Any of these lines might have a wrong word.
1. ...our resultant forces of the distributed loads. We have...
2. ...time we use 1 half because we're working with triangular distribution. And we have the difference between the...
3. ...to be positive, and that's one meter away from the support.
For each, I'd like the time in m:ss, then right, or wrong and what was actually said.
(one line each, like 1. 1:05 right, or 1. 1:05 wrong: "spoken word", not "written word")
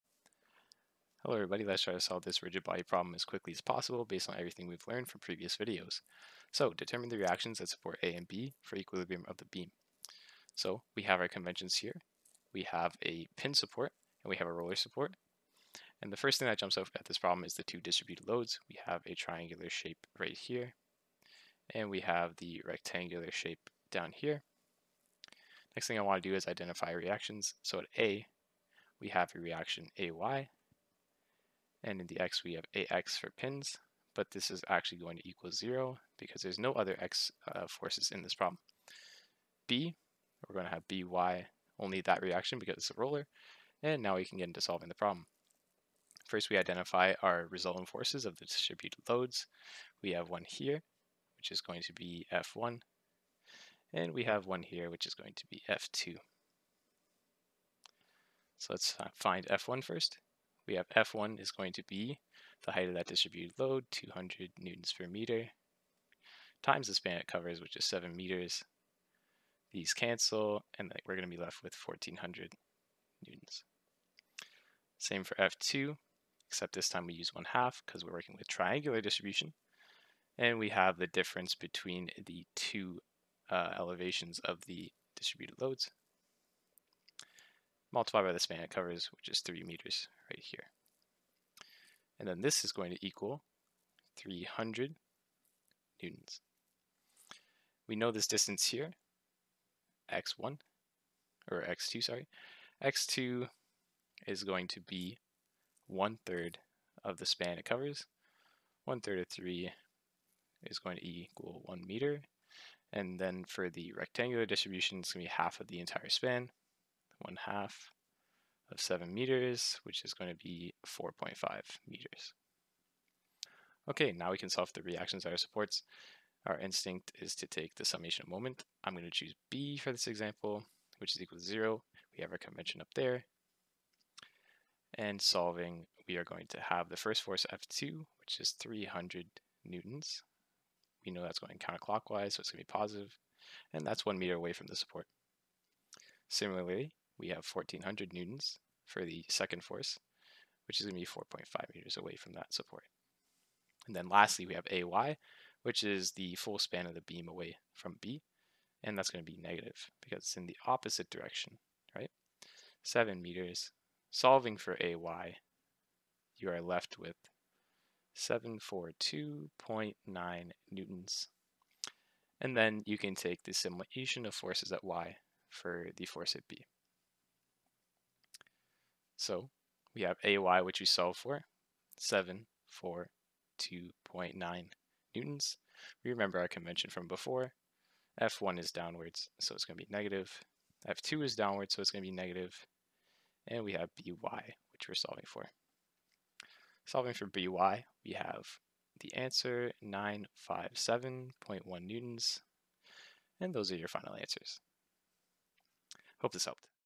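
1. 0:47 right
2. 1:16 right
3. 2:22 right.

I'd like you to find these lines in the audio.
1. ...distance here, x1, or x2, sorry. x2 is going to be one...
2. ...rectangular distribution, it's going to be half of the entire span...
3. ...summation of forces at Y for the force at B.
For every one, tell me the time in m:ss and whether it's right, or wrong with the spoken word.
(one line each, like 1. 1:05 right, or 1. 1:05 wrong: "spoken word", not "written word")
1. 1:38 right
2. 1:53 right
3. 2:53 right.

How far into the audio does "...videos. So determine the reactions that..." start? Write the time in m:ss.
0:05.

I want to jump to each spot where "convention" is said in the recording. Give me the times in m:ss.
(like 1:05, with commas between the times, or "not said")
0:11, 2:12, 3:06.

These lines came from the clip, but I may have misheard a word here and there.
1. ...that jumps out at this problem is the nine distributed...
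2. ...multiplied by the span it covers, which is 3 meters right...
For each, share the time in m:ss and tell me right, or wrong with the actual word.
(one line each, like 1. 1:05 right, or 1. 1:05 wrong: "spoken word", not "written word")
1. 0:16 wrong: "two", not "nine"
2. 1:27 right.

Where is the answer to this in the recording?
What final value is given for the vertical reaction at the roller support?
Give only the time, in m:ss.
3:19.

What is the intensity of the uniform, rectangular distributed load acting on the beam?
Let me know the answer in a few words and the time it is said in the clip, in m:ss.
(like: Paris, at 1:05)
200 N/m, at 1:03.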